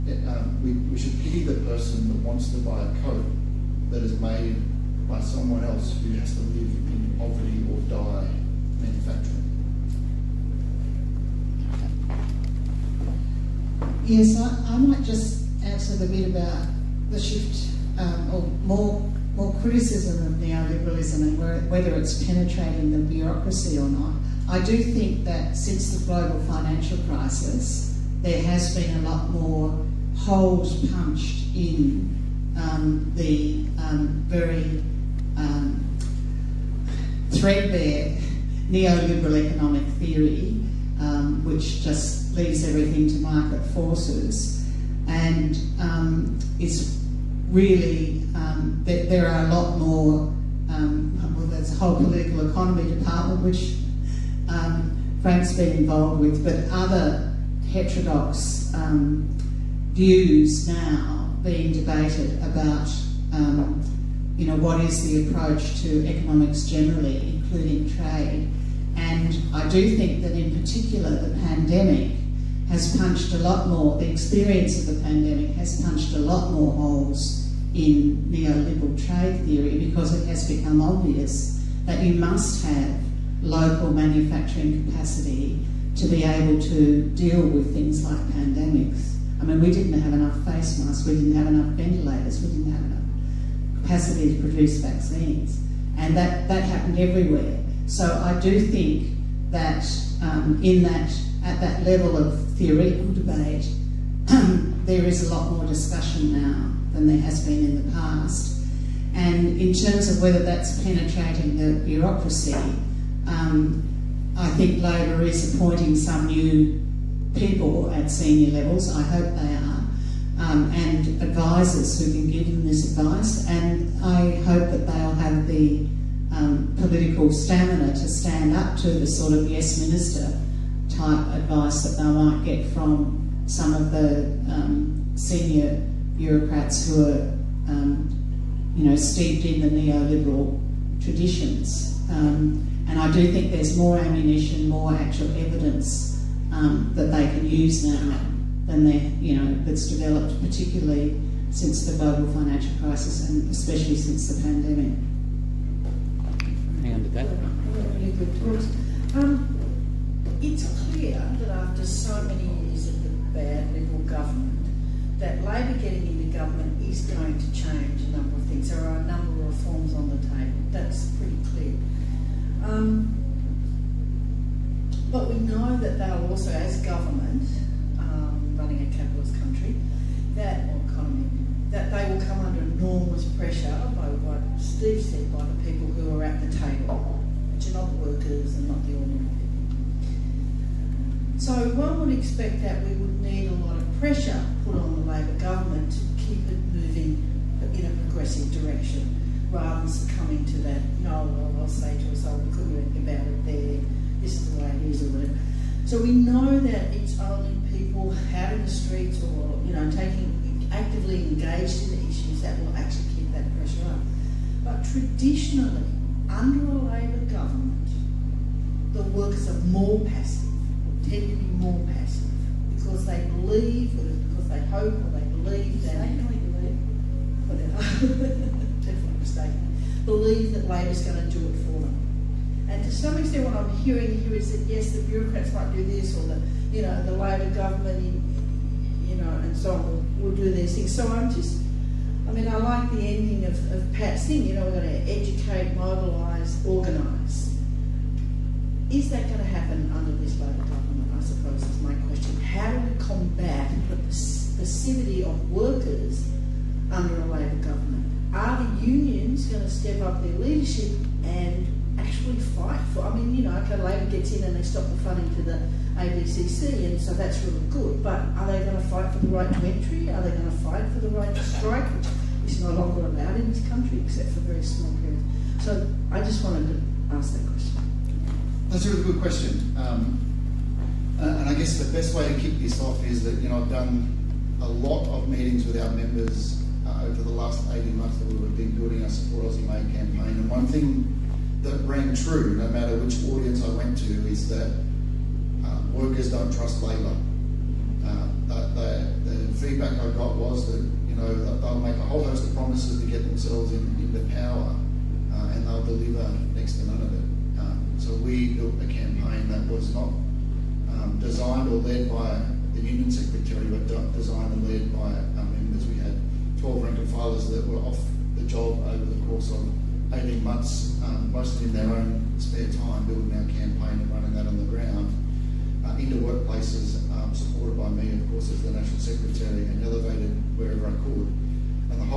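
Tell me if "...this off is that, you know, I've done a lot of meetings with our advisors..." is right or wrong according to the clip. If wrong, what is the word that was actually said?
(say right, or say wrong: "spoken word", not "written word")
wrong: "members", not "advisors".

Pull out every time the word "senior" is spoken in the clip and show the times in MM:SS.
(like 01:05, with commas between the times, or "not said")
01:58, 02:15.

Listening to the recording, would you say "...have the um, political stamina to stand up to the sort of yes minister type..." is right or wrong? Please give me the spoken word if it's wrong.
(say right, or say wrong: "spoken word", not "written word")
right.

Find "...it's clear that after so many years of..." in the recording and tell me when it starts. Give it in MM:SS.
02:40.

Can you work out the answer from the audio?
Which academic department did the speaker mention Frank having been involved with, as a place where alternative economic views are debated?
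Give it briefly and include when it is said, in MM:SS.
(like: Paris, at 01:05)
political economy department, at 00:51.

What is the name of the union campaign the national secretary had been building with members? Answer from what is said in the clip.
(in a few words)
Support Aussie Made.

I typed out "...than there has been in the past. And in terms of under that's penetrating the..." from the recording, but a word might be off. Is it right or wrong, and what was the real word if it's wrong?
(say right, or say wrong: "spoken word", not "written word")
wrong: "whether", not "under".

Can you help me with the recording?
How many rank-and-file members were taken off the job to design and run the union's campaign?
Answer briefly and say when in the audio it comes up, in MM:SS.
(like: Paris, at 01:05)
12, at 05:16.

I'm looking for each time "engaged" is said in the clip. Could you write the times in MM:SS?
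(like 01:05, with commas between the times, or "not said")
03:31.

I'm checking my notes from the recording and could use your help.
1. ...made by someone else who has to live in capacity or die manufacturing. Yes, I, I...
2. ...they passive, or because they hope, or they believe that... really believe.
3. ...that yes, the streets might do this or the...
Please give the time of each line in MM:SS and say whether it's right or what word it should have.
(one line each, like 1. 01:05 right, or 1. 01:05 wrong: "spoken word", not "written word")
1. 00:04 wrong: "poverty", not "capacity"
2. 03:43 wrong: "believe", not "passive"
3. 03:54 wrong: "bureaucrats", not "streets".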